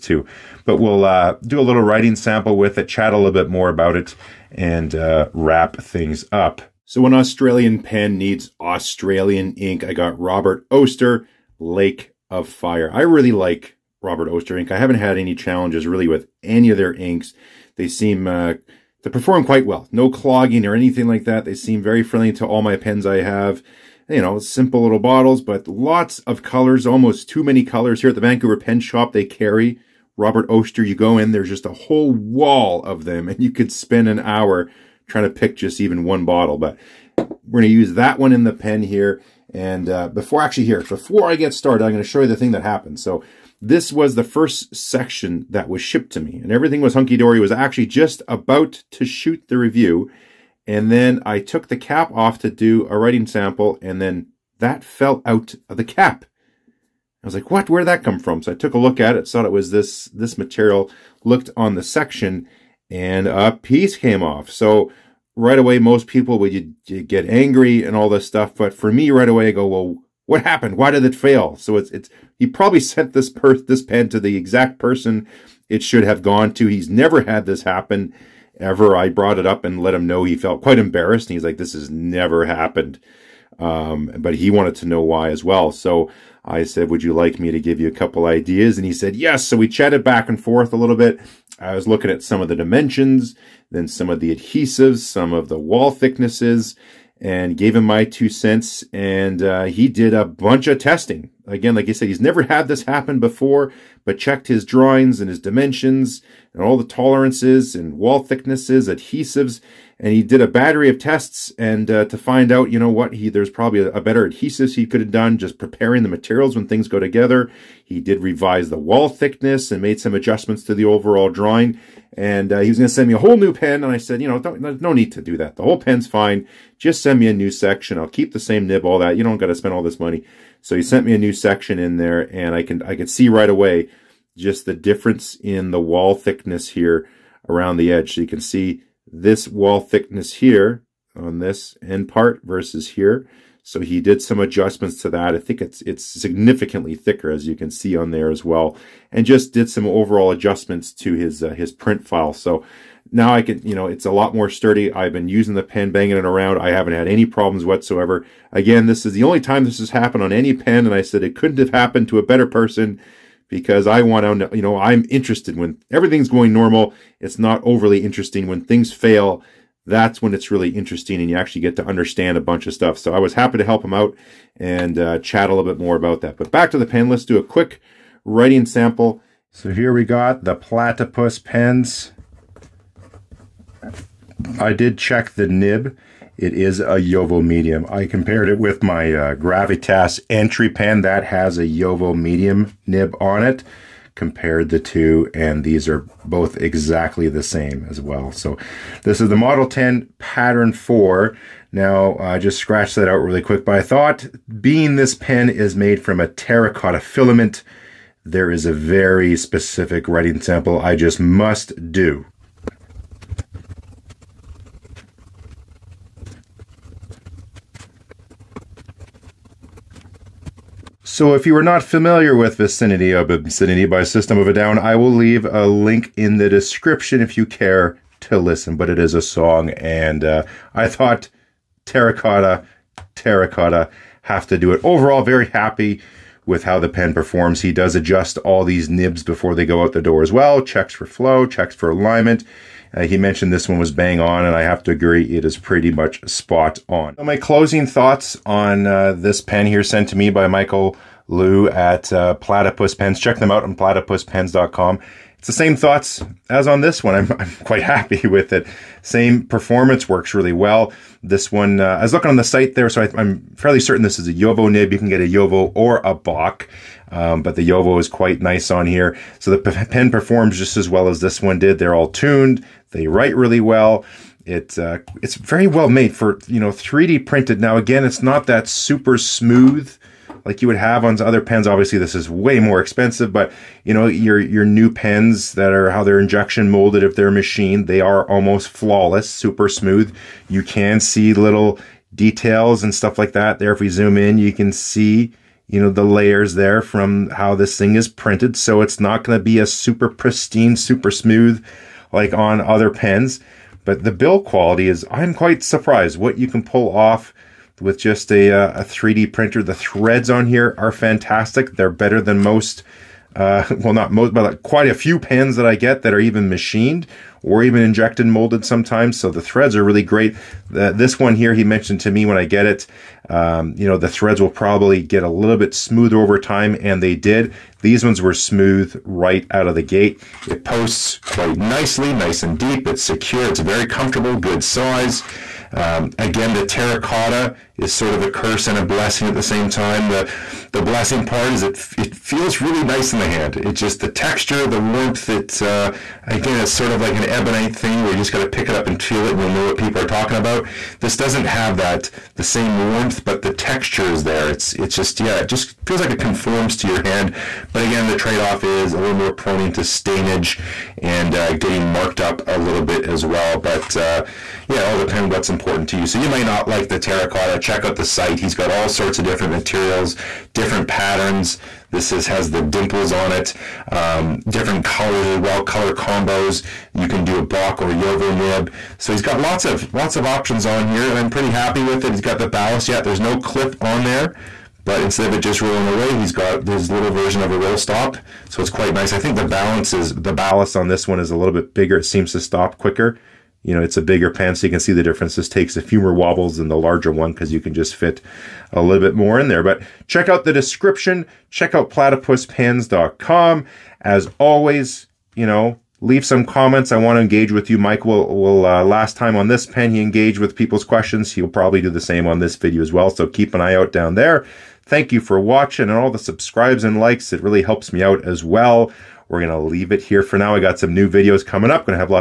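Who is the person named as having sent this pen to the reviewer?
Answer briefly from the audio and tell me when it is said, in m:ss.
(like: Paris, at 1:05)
Michael Lou, at 4:10.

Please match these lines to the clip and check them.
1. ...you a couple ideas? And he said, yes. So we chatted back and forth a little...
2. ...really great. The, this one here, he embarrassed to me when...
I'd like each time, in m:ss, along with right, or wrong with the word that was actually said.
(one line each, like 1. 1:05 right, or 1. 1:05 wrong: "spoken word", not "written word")
1. 1:27 right
2. 5:19 wrong: "mentioned", not "embarrassed".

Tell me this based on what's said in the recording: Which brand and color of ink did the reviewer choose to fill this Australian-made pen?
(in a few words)
Robert Oster Lake of Fire.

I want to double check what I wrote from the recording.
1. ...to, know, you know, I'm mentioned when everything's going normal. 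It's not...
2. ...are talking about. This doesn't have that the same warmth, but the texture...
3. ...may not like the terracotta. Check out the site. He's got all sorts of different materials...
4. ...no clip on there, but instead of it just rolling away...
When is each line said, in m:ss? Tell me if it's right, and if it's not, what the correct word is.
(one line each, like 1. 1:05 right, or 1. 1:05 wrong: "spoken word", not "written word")
1. 2:44 wrong: "interested", not "mentioned"
2. 5:50 right
3. 6:06 right
4. 6:23 right.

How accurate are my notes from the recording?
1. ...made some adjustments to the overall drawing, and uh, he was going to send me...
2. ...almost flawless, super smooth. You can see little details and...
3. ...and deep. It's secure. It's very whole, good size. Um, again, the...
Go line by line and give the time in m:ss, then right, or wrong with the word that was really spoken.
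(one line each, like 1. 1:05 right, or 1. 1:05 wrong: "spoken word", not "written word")
1. 1:59 right
2. 4:48 right
3. 5:32 wrong: "comfortable", not "whole".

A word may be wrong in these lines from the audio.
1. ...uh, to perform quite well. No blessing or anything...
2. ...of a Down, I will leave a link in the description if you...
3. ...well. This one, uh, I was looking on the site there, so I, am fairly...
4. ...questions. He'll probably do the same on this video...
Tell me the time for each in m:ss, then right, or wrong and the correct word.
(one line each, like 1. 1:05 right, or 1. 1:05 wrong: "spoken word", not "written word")
1. 0:18 wrong: "clogging", not "blessing"
2. 3:44 right
3. 4:20 right
4. 6:50 right.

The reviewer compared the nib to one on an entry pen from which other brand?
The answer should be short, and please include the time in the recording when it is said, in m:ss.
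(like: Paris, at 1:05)
Gravitas, at 3:09.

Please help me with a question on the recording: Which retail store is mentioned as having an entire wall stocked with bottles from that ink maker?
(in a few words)
Vancouver Pen Shop.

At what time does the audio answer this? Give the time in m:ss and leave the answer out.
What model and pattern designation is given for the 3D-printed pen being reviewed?
3:19.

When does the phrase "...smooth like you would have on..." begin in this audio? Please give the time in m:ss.
4:39.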